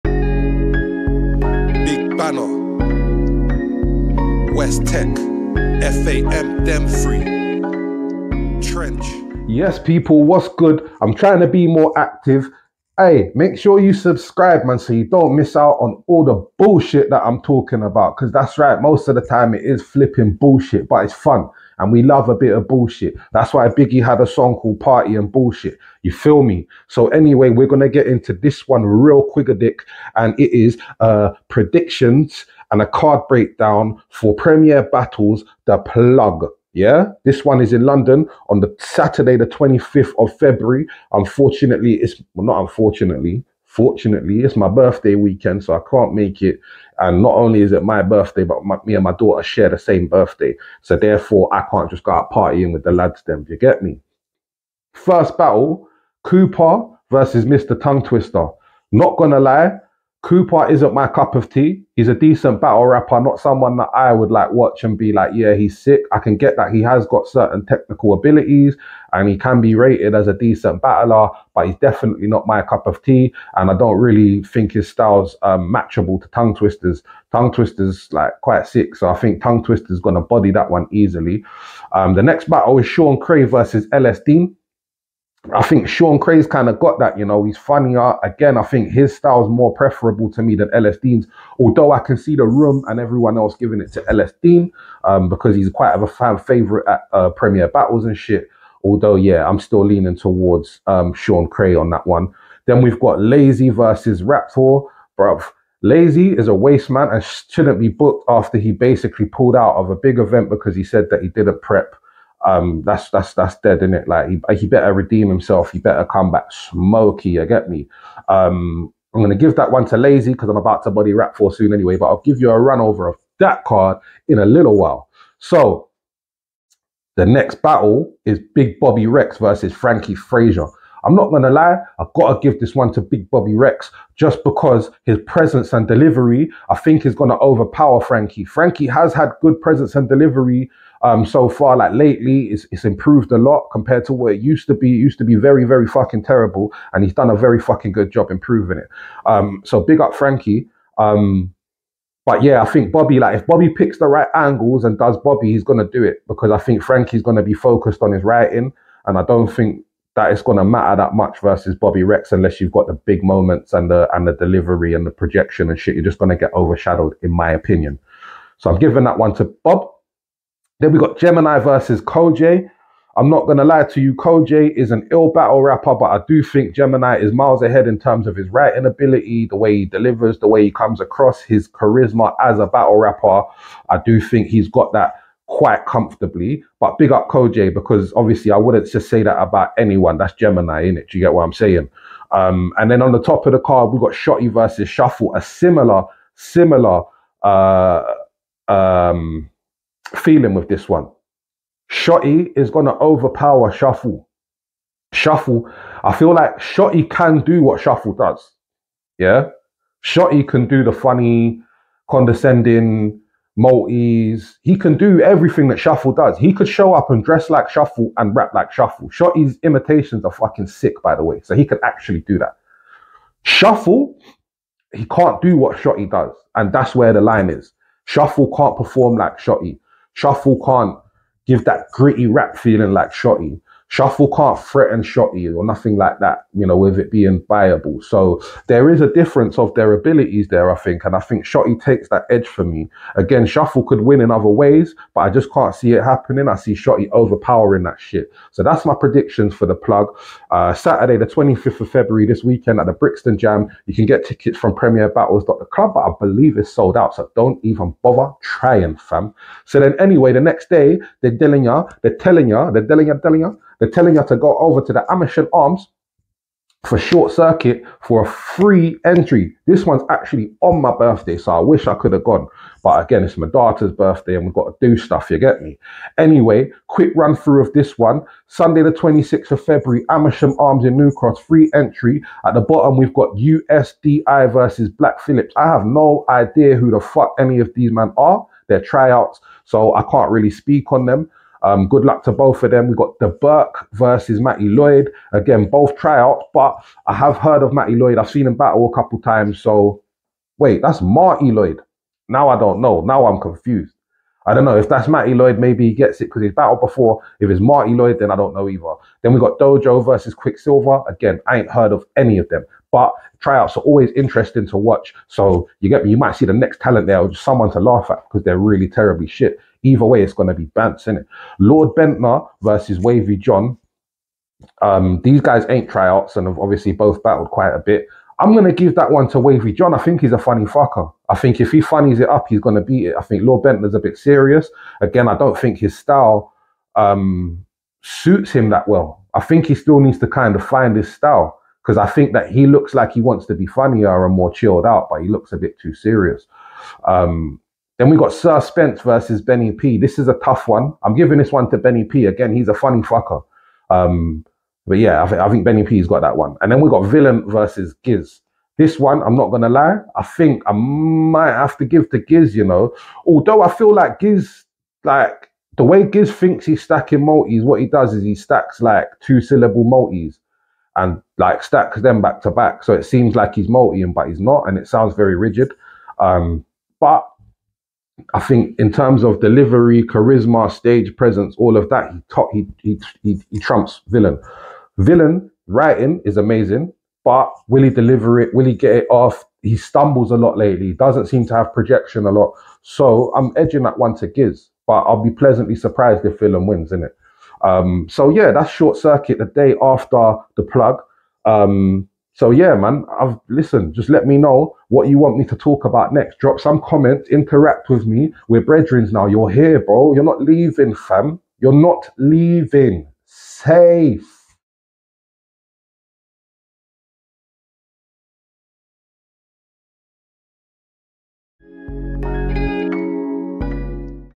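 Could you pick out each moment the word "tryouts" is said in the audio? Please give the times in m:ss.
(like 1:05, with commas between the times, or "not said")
4:48, 4:55, 5:13, 5:25.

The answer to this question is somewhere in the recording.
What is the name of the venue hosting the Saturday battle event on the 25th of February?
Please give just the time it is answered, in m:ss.
4:12.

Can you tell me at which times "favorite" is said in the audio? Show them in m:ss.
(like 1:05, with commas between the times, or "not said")
1:36.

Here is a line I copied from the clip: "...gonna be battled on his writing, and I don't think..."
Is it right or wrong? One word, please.
wrong.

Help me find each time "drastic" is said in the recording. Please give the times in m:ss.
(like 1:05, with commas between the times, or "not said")
not said.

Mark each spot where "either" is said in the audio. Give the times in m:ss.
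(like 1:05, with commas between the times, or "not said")
5:08, 5:19.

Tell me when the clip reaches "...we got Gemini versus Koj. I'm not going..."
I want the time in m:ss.
2:50.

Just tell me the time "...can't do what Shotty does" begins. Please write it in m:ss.
3:45.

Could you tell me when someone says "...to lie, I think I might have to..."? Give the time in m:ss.
5:59.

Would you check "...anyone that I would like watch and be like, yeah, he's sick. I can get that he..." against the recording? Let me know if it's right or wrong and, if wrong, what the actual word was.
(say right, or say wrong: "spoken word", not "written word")
wrong: "someone", not "anyone".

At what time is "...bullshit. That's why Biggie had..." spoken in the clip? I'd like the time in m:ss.
0:22.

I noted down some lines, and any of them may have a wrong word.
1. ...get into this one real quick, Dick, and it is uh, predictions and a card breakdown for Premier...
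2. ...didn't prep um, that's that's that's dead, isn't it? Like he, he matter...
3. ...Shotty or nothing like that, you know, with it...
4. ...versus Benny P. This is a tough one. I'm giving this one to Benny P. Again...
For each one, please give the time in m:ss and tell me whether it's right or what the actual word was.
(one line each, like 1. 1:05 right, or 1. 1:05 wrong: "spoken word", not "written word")
1. 0:27 right
2. 1:51 wrong: "better", not "matter"
3. 3:55 right
4. 5:49 right.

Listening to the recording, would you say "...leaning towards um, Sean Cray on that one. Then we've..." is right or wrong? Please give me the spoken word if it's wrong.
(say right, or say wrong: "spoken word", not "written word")
right.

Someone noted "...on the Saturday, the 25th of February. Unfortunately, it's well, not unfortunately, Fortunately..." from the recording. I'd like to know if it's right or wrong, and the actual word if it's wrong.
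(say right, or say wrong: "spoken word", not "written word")
right.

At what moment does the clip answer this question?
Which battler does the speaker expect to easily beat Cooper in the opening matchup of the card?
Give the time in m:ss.
1:19.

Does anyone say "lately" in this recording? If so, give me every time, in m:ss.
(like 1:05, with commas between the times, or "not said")
2:21, 6:30.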